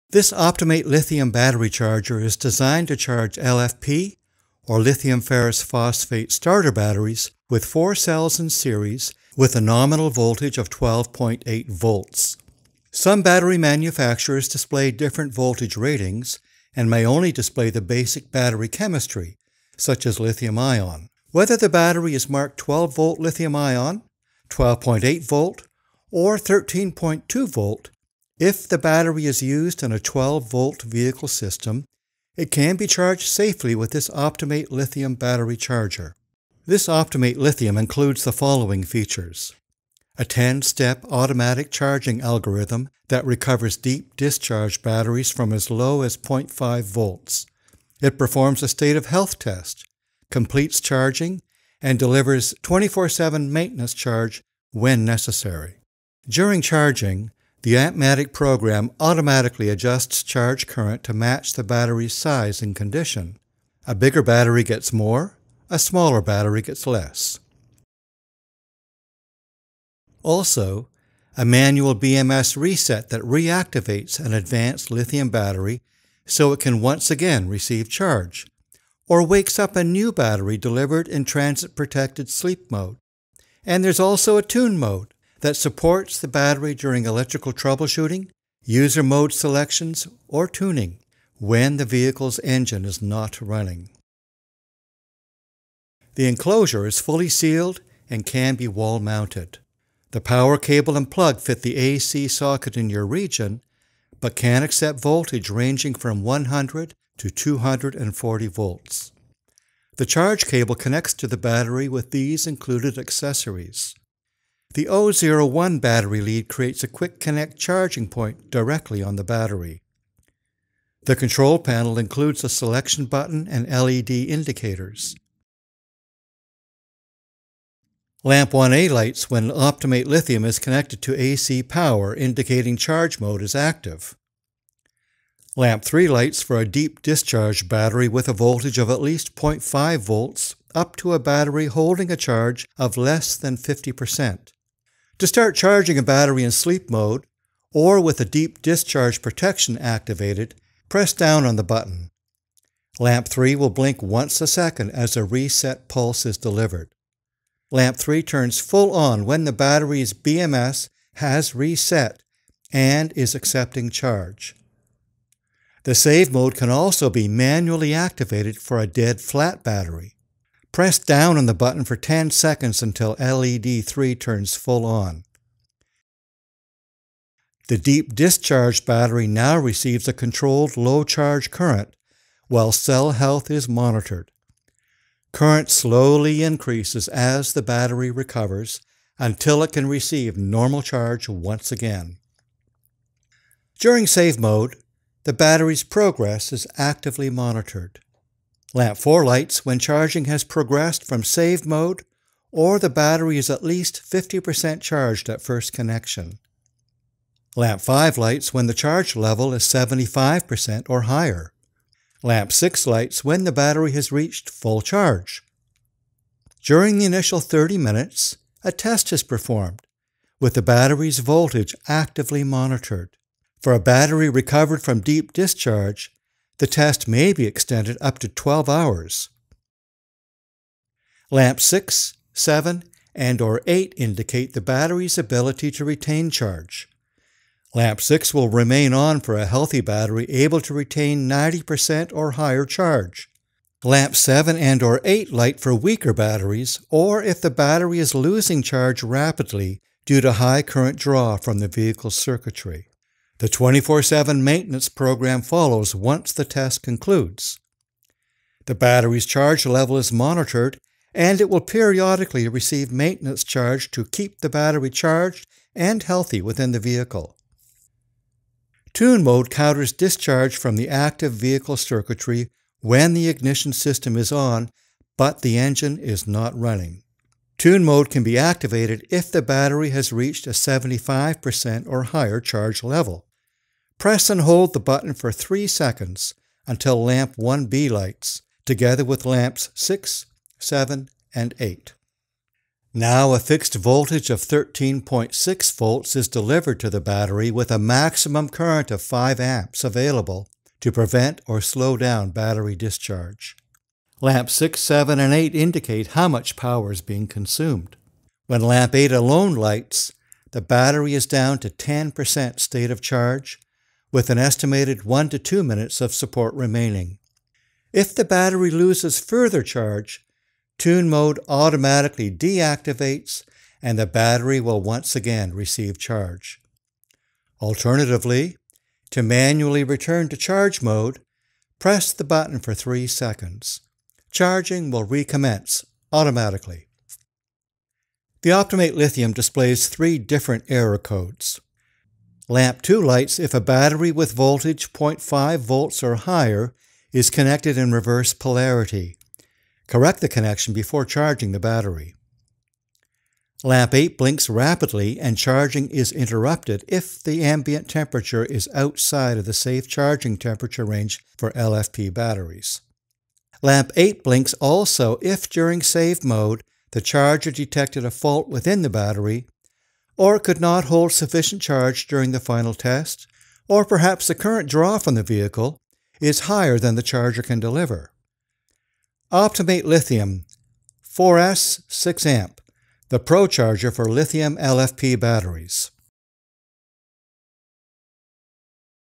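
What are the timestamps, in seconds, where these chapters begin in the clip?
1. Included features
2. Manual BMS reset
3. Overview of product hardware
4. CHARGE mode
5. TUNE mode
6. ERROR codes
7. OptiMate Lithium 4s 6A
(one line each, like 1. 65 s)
1. 36 s
2. 71 s
3. 96 s
4. 125 s
5. 269 s
6. 339 s
7. 379 s.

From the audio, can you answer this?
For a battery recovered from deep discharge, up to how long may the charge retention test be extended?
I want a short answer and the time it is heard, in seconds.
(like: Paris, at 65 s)
12 hours, at 228 s.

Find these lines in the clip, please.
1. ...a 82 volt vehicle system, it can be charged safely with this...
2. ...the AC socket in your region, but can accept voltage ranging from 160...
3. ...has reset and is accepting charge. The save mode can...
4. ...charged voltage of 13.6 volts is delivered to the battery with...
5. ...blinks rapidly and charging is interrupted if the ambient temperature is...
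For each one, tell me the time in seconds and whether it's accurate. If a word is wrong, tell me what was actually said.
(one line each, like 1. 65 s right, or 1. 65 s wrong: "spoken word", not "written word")
1. 29 s wrong: "12", not "82"
2. 101 s wrong: "100", not "160"
3. 161 s right
4. 293 s wrong: "fixed", not "charged"
5. 354 s right.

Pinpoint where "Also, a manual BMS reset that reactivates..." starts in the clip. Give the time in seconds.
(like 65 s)
70 s.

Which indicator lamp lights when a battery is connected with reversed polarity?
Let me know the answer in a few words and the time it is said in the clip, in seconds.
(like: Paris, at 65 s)
Lamp 2, at 342 s.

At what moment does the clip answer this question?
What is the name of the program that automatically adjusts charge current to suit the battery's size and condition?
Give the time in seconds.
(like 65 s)
57 s.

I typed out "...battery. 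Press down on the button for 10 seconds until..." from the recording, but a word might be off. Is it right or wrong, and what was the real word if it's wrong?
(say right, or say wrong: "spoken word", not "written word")
right.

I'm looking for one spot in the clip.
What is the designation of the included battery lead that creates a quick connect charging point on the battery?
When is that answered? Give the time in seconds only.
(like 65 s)
114 s.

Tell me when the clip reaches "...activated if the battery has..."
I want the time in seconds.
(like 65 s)
278 s.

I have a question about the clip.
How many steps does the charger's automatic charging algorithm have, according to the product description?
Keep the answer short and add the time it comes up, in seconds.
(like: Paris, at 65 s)
10, at 40 s.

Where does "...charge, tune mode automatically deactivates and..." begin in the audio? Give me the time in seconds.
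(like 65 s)
319 s.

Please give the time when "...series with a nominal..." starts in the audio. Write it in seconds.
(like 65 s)
8 s.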